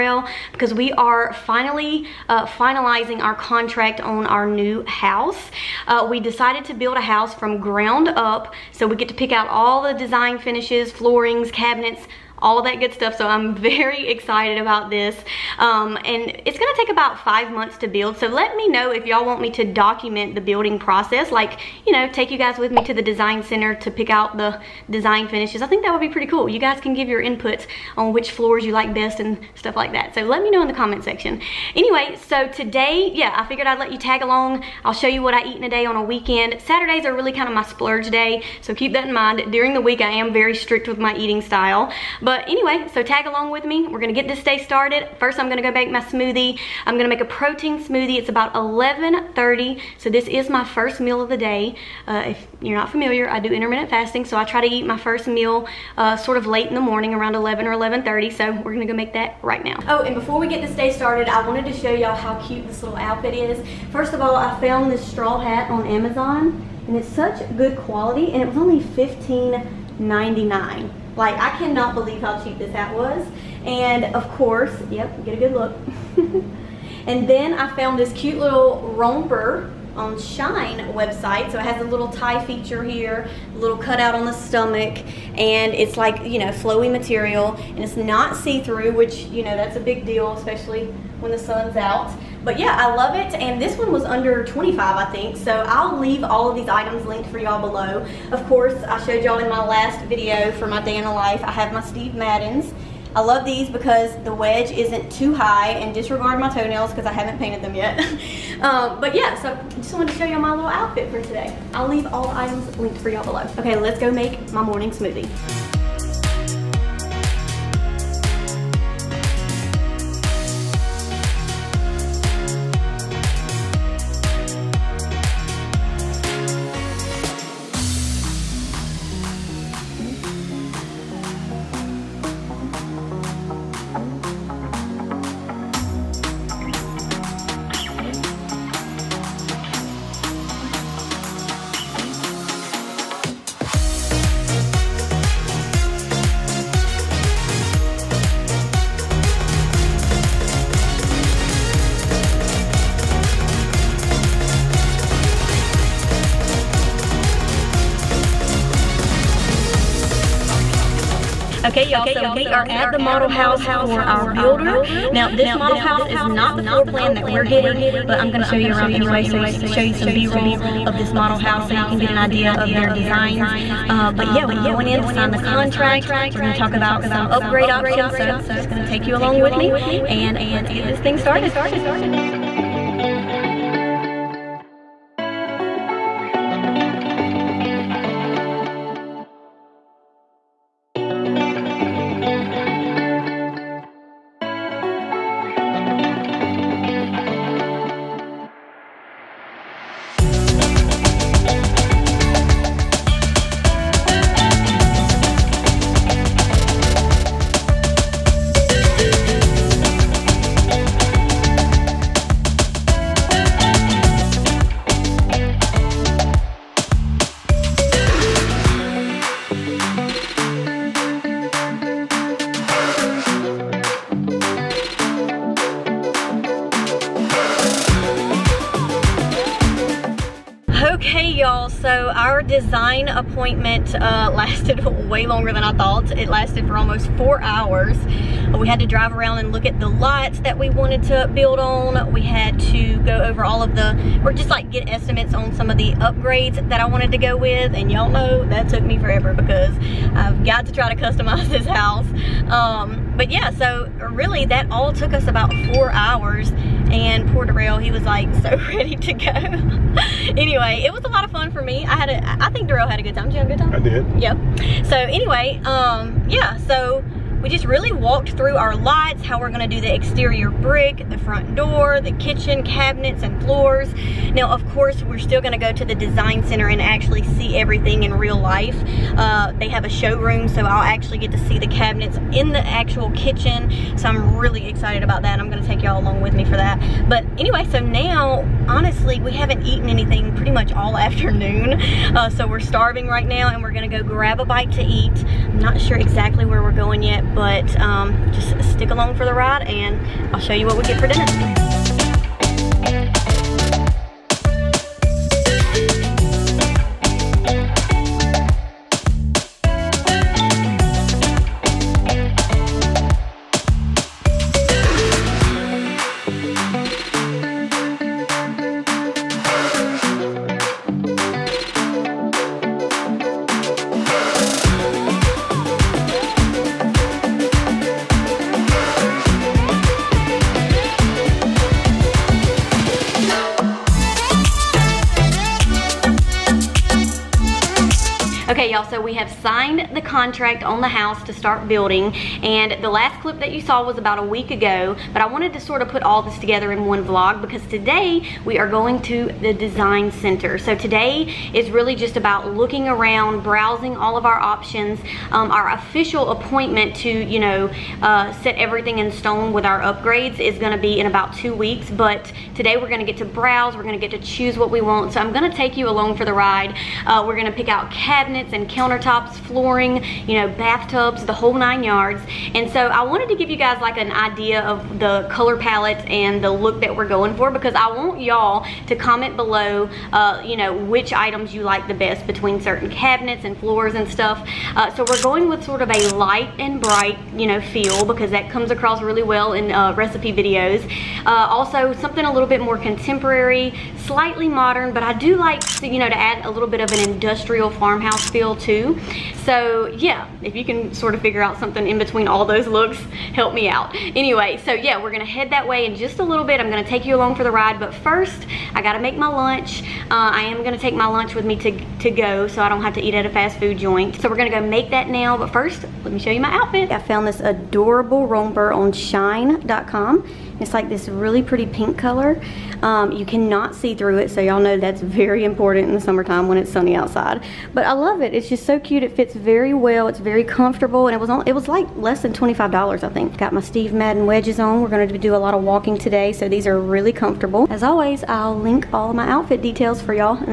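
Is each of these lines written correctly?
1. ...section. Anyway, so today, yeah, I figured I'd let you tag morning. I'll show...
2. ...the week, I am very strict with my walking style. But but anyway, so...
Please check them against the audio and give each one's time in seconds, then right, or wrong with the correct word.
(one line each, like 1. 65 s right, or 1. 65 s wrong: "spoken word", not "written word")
1. 31 s wrong: "along", not "morning"
2. 39 s wrong: "eating", not "walking".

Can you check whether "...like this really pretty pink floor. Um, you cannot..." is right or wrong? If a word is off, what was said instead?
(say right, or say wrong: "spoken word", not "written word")
wrong: "color", not "floor".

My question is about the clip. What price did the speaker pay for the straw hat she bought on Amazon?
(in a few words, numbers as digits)
$15.99.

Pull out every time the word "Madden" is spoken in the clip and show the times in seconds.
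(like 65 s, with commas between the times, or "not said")
102 s, 433 s.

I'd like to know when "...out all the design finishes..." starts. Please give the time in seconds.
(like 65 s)
9 s.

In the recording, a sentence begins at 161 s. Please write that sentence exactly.
Okay, y'all, so we are at the model house for our builder.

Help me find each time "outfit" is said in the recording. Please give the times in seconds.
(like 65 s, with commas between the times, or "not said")
62 s, 110 s, 416 s, 439 s.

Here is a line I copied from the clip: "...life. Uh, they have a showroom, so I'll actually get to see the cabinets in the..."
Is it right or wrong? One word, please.
right.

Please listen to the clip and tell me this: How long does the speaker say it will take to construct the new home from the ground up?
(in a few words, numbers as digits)
5 months.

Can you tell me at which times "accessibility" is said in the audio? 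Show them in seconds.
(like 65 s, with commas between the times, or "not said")
not said.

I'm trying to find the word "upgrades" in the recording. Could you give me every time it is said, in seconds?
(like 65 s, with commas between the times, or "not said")
177 s, 245 s, 359 s.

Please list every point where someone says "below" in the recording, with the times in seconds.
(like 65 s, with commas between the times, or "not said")
97 s, 113 s, 379 s.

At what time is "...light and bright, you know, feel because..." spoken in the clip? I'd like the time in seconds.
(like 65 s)
386 s.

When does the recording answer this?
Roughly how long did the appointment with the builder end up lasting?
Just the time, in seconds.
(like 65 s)
236 s.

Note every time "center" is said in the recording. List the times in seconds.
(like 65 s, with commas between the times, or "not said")
23 s, 276 s, 350 s.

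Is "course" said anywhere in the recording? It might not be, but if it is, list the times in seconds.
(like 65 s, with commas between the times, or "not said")
74 s, 98 s, 274 s.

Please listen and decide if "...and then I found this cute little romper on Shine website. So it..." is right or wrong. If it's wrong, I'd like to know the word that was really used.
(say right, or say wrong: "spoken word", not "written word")
right.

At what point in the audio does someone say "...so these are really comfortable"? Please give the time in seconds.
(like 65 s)
436 s.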